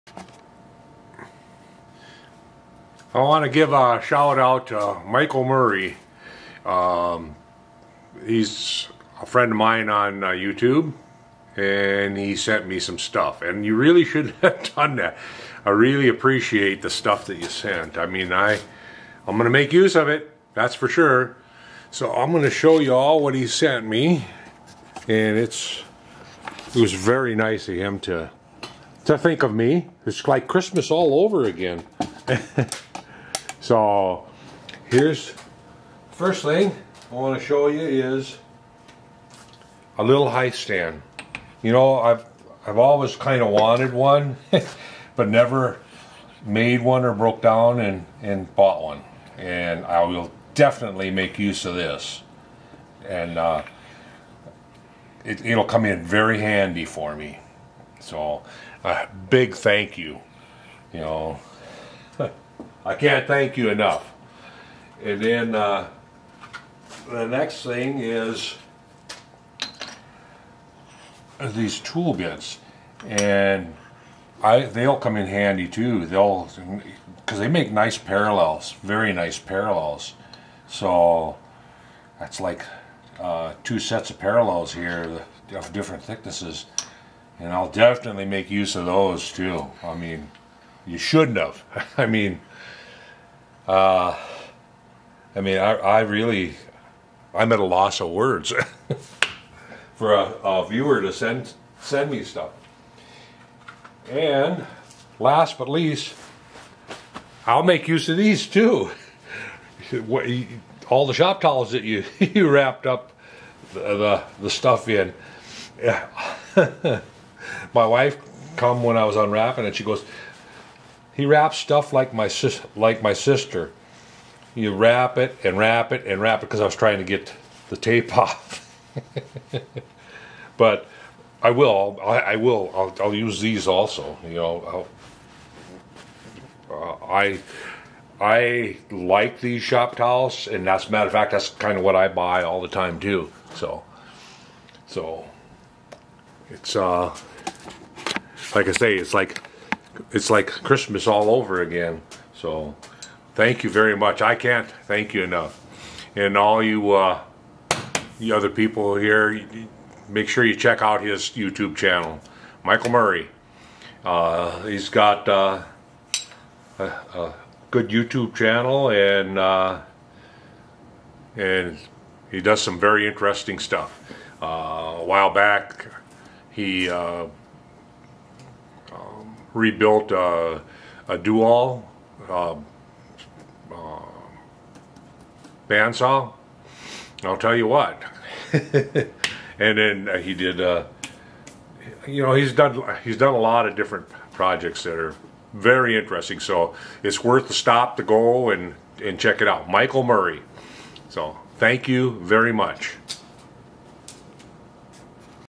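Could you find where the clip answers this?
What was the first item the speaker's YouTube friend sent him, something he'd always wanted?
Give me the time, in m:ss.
0:40.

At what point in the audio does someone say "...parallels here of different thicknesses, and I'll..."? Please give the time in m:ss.
1:24.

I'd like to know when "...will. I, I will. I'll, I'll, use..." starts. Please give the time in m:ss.
2:11.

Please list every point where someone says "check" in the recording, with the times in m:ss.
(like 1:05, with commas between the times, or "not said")
2:40, 3:19.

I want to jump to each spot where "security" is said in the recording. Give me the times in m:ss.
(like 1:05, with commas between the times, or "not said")
not said.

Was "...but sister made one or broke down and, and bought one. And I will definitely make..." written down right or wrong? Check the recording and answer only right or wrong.
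wrong.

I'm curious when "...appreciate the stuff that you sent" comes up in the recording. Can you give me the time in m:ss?
0:16.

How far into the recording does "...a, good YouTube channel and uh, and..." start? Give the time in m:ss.
2:46.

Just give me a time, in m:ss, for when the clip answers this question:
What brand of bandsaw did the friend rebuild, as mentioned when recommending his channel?
3:01.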